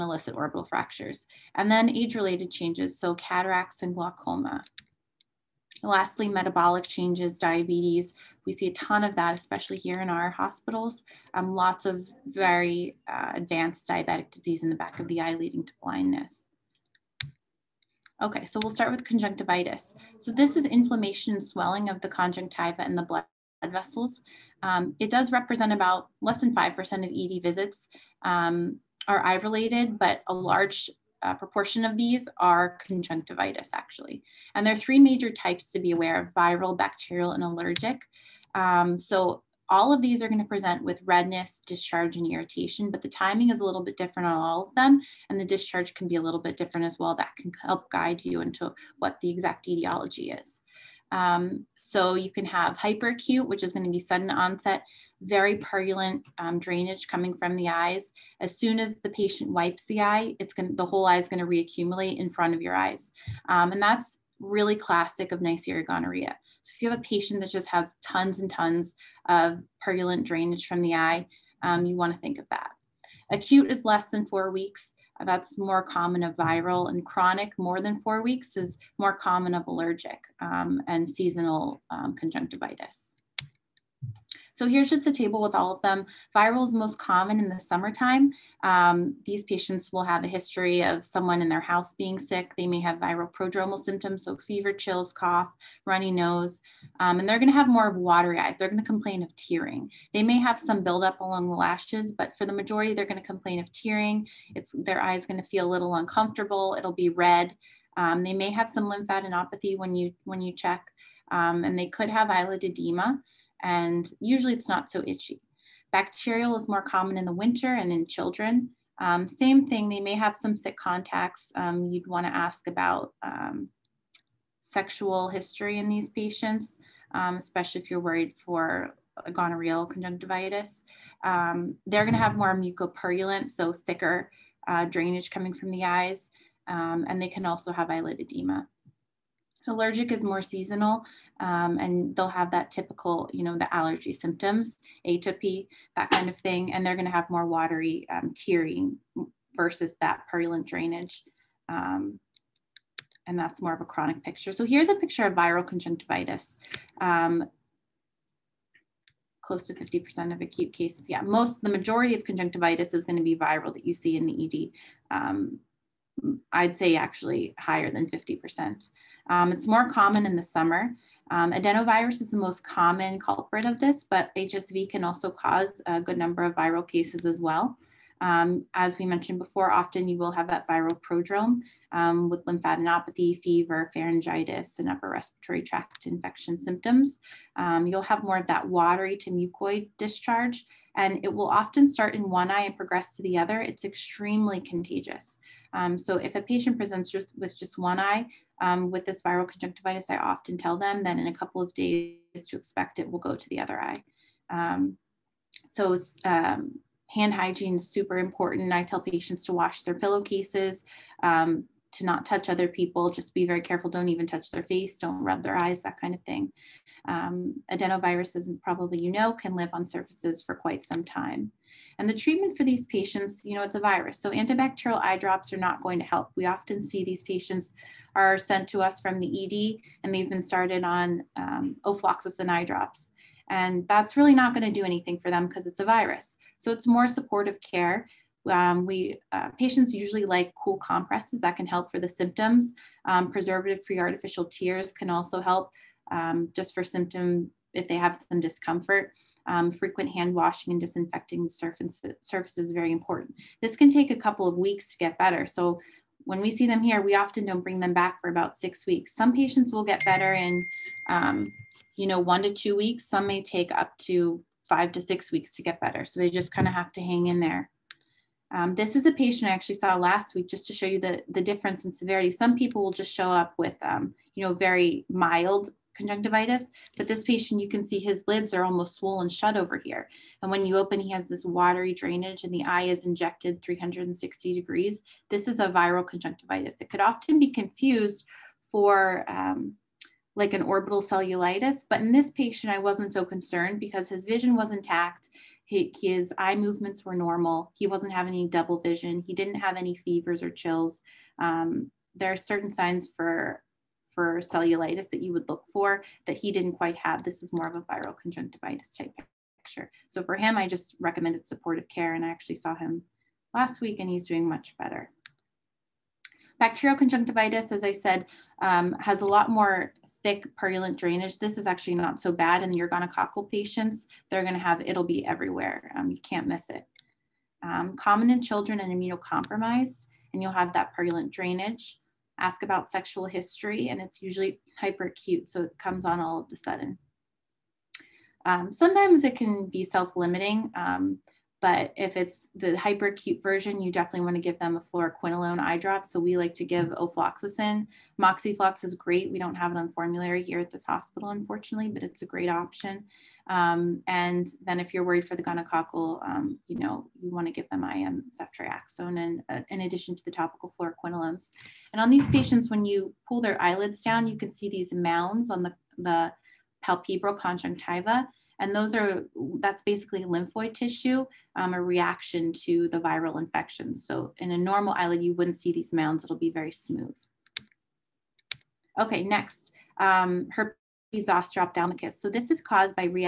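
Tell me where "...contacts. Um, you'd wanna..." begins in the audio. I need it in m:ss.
2:00.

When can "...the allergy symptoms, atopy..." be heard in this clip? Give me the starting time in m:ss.
2:23.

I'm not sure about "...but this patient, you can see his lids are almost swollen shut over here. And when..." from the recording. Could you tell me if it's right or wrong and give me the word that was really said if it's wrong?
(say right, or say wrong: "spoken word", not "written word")
right.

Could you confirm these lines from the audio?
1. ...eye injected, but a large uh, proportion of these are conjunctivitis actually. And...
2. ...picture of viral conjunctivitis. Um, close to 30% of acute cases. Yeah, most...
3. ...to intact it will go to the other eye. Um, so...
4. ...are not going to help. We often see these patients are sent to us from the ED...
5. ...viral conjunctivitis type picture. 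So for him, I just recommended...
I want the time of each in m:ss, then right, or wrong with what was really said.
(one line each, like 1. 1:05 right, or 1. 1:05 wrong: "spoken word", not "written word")
1. 0:29 wrong: "related", not "injected"
2. 2:34 wrong: "50", not "30"
3. 3:22 wrong: "expect", not "intact"
4. 3:45 right
5. 5:07 right.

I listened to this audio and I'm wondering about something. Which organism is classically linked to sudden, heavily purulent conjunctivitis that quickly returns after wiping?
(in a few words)
Neisseria gonorrhea.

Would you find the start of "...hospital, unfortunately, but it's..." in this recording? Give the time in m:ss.
5:50.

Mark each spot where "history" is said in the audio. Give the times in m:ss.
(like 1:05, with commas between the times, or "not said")
1:30, 2:05, 5:33.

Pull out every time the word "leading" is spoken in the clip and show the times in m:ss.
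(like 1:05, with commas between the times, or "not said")
0:15.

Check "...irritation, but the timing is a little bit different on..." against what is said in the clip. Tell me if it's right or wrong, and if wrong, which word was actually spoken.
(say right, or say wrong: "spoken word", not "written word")
right.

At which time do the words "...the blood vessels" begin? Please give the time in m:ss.
0:22.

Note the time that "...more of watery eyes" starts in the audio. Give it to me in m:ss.
1:37.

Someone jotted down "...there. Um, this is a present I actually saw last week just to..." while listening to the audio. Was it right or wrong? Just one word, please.
wrong.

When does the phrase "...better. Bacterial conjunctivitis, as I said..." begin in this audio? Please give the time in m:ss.
5:14.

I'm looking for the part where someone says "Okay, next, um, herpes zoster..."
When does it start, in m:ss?
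6:18.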